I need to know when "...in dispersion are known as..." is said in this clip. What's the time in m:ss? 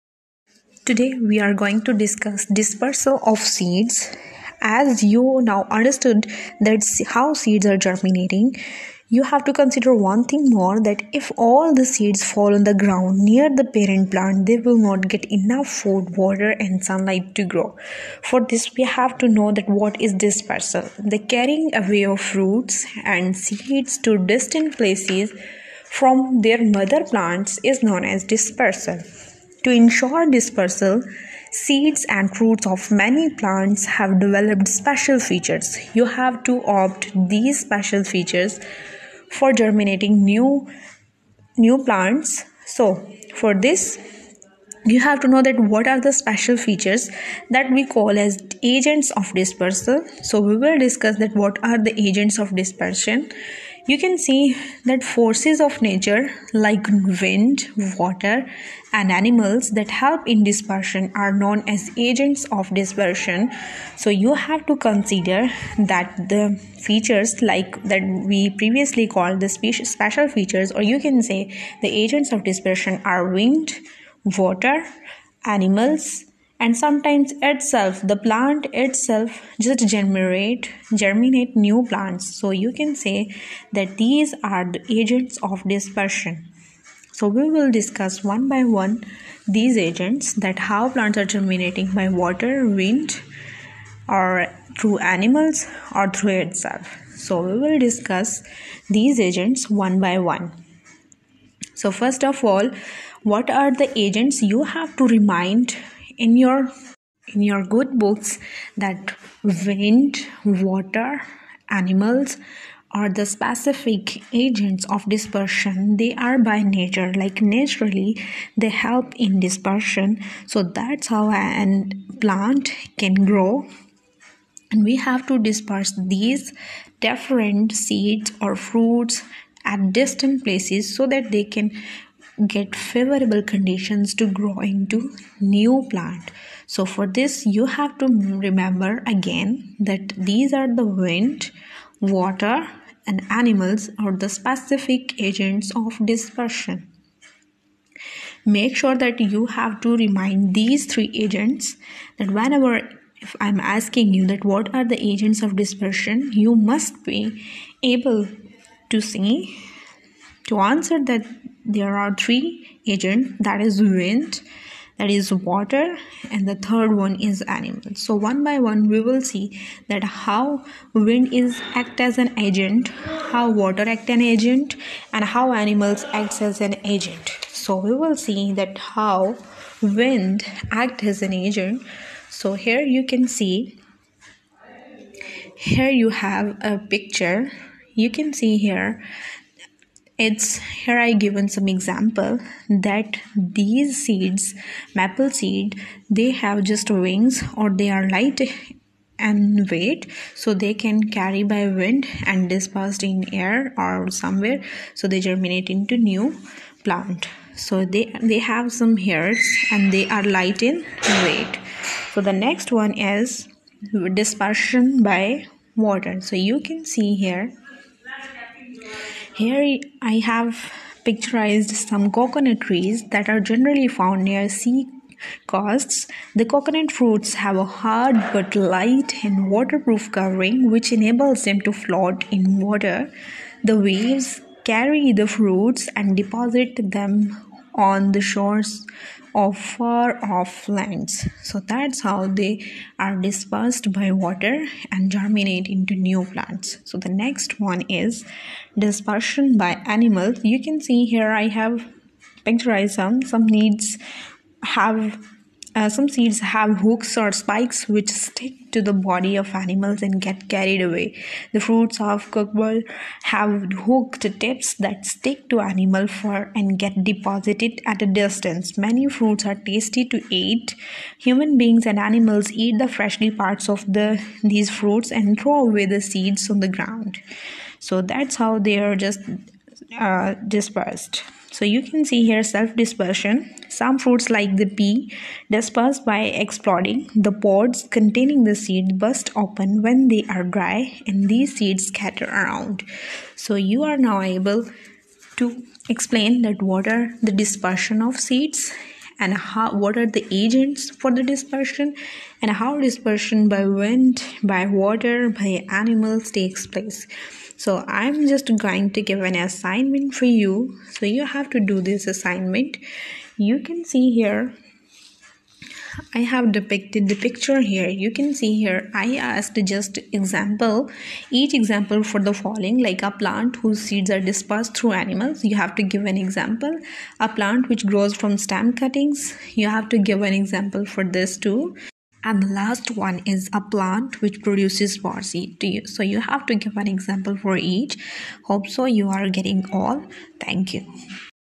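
1:00.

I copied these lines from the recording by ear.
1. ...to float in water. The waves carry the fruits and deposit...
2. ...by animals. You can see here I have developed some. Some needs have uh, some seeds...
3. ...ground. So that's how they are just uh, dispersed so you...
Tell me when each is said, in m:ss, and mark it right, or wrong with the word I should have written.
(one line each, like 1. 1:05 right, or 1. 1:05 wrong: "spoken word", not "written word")
1. 3:51 right
2. 4:09 wrong: "picturized", not "developed"
3. 4:36 right.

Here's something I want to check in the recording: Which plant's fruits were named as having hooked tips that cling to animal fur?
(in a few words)
Cocklebur.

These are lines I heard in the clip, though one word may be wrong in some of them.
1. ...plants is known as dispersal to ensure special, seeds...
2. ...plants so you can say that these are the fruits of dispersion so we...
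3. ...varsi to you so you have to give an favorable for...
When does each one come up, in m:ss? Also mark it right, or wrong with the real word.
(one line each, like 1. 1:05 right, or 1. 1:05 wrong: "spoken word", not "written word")
1. 0:27 wrong: "dispersal", not "special"
2. 1:21 wrong: "agents", not "fruits"
3. 5:35 wrong: "example", not "favorable".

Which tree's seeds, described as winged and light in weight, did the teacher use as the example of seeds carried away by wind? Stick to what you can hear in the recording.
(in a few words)
Maple.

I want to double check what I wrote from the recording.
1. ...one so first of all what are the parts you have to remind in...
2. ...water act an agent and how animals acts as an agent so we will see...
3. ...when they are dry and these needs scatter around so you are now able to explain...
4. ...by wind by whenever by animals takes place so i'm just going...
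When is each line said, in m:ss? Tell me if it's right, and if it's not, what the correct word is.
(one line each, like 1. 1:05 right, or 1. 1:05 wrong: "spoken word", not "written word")
1. 1:40 wrong: "agents", not "parts"
2. 2:53 right
3. 4:49 wrong: "seeds", not "needs"
4. 5:03 wrong: "water", not "whenever".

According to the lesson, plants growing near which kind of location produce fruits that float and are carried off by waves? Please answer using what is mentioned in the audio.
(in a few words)
Sea coasts.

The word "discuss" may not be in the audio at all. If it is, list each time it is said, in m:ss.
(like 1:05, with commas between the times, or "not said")
0:01, 0:50, 1:27, 1:37.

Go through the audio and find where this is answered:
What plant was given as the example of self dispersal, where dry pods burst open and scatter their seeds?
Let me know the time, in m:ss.
4:44.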